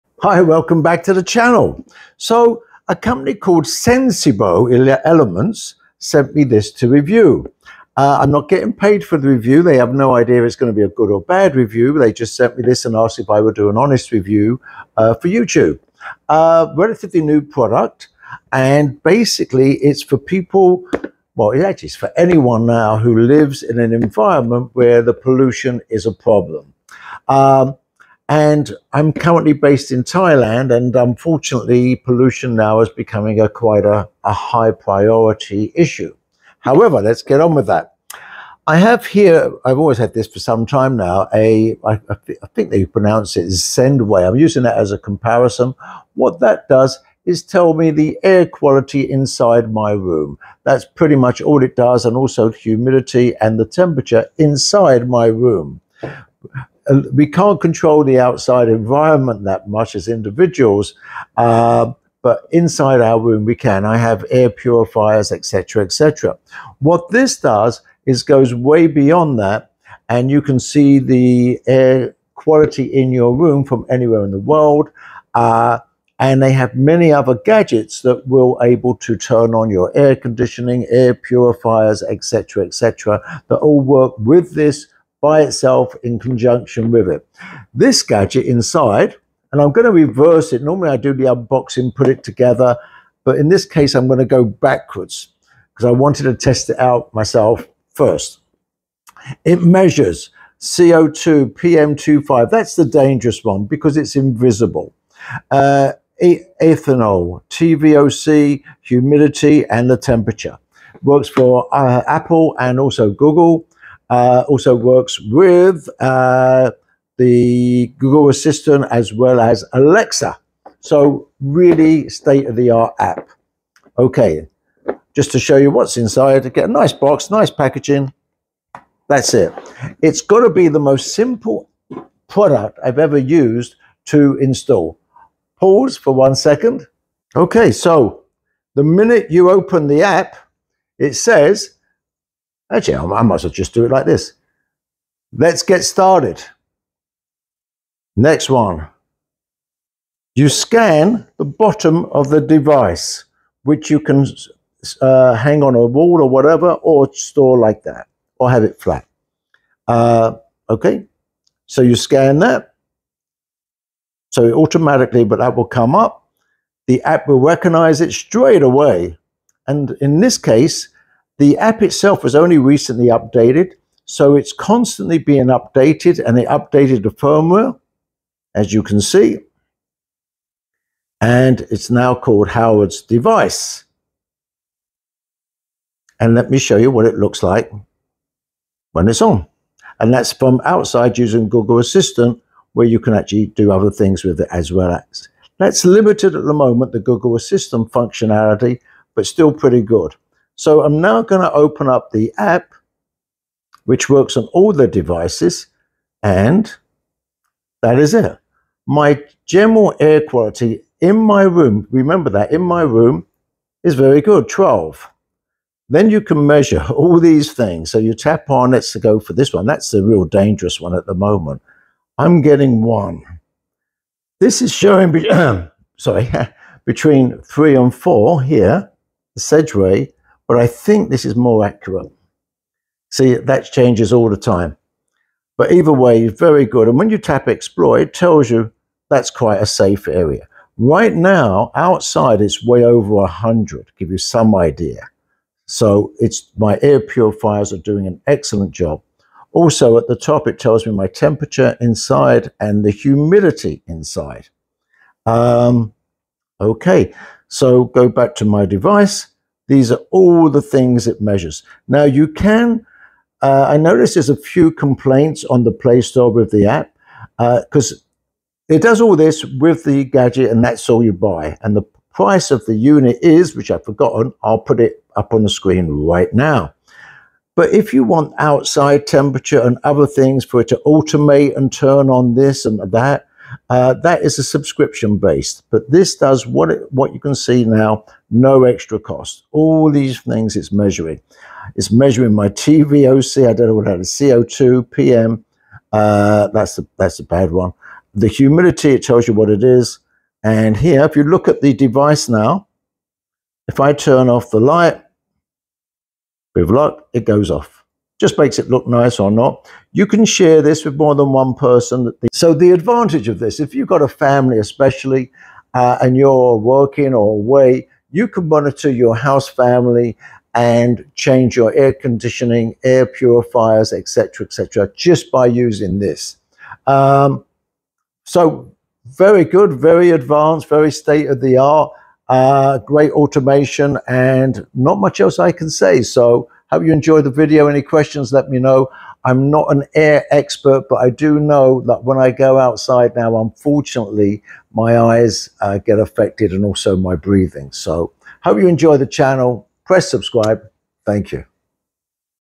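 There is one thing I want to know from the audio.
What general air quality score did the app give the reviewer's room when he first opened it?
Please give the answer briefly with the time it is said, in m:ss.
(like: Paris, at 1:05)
12, at 3:34.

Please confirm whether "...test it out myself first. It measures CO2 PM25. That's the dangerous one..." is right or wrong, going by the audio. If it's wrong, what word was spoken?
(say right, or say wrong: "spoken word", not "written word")
right.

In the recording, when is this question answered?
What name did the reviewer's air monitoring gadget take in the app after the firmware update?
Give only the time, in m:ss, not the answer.
3:02.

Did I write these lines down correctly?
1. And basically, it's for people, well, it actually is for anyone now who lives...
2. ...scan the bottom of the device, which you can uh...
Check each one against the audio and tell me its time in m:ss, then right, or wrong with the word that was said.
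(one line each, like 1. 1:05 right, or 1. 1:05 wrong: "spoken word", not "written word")
1. 0:18 right
2. 2:30 right.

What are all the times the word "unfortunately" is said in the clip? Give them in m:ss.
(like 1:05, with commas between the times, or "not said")
0:30, 5:43.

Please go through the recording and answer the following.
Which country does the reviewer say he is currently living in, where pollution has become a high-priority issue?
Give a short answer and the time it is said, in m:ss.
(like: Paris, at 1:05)
Thailand, at 0:30.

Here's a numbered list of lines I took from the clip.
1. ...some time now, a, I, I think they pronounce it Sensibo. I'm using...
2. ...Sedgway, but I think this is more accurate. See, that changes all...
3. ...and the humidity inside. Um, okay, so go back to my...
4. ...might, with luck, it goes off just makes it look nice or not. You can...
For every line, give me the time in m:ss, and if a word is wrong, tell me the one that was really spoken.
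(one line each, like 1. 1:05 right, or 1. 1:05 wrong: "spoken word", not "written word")
1. 0:40 wrong: "Zendway", not "Sensibo"
2. 3:49 right
3. 4:12 right
4. 5:04 wrong: "light", not "might".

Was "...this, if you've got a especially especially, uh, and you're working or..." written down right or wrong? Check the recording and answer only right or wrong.
wrong.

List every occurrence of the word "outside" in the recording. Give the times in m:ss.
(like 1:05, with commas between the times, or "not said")
0:58, 3:10, 4:01, 4:38, 5:42.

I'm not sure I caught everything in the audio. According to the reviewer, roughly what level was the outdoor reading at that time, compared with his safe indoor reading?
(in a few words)
over 100.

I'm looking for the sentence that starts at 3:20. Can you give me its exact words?
So I'm now going to open up the app, which works on all the devices, and that is it.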